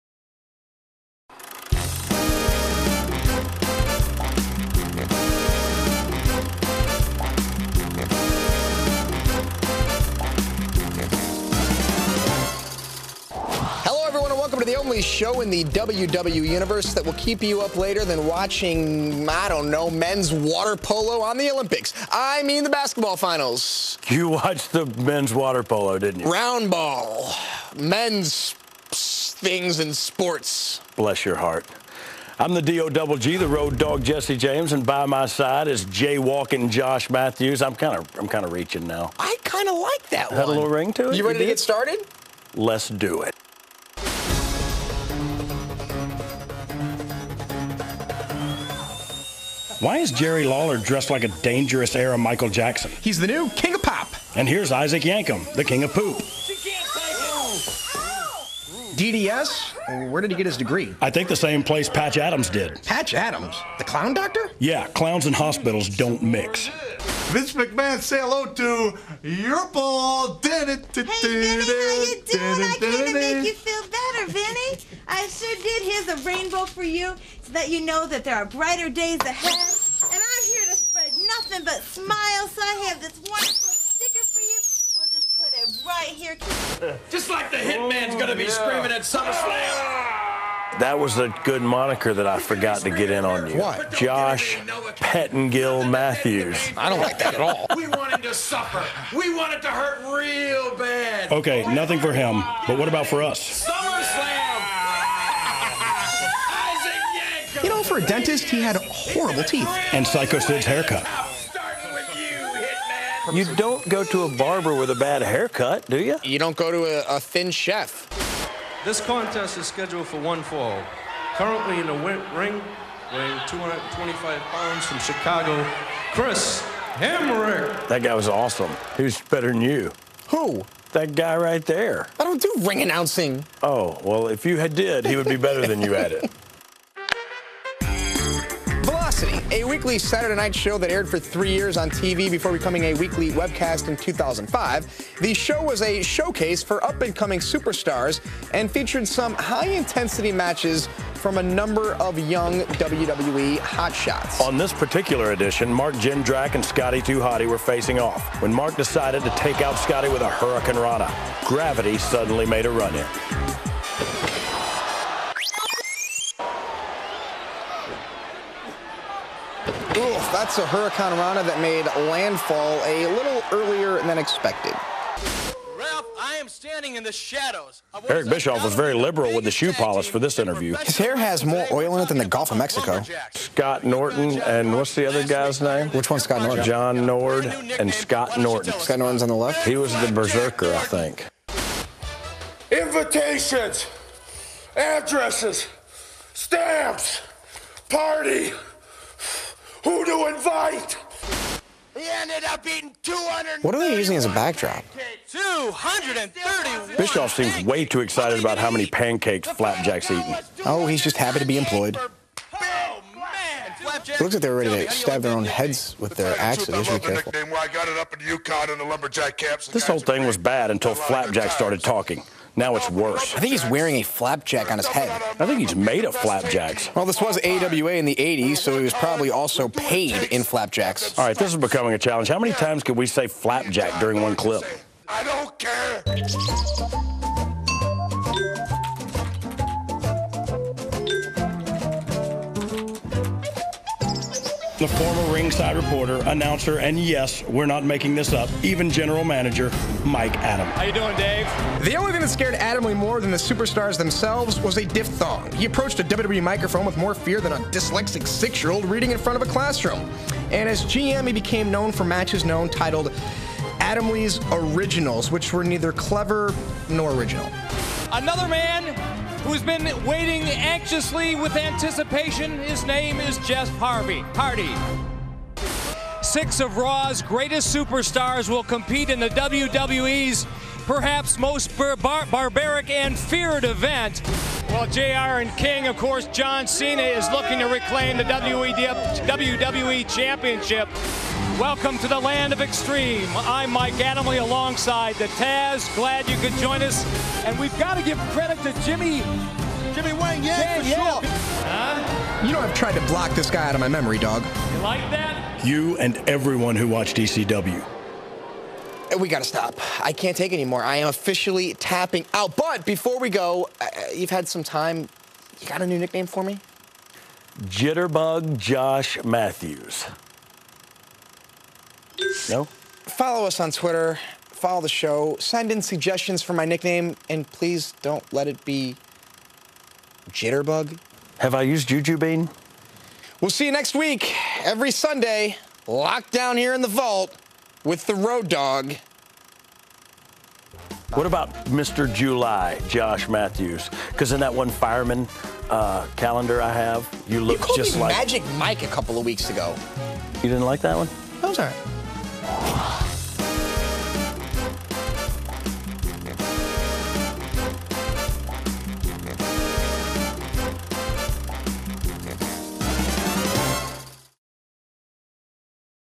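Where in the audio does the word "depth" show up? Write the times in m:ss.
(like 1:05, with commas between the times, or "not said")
not said.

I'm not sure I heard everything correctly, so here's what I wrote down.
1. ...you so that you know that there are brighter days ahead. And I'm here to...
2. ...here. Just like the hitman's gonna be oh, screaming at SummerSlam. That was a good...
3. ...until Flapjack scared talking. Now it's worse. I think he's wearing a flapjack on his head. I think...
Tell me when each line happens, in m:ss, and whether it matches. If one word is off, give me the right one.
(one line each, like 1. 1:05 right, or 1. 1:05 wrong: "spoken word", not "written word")
1. 1:16 right
2. 1:26 right
3. 3:40 wrong: "started", not "scared".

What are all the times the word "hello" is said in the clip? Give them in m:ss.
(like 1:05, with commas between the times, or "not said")
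0:13, 1:08.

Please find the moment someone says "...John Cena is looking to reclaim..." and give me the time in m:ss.
4:46.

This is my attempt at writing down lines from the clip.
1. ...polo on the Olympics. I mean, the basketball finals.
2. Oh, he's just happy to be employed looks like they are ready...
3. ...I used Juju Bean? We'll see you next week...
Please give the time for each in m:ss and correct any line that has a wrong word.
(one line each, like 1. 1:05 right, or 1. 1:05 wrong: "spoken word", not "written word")
1. 0:20 right
2. 3:30 right
3. 5:31 right.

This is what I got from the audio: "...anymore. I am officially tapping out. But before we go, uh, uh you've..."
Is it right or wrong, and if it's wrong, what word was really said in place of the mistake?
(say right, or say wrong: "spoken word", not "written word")
right.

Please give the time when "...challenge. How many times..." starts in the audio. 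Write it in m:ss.
3:51.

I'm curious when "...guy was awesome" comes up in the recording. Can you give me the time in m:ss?
2:08.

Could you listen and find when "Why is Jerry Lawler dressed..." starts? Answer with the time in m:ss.
0:49.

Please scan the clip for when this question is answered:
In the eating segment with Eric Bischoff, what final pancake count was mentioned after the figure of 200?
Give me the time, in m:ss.
3:25.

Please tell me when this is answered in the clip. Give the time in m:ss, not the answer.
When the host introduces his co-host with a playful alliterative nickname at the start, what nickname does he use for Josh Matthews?
0:35.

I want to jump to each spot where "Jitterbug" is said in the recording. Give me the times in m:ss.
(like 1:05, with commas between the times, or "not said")
5:17, 5:30.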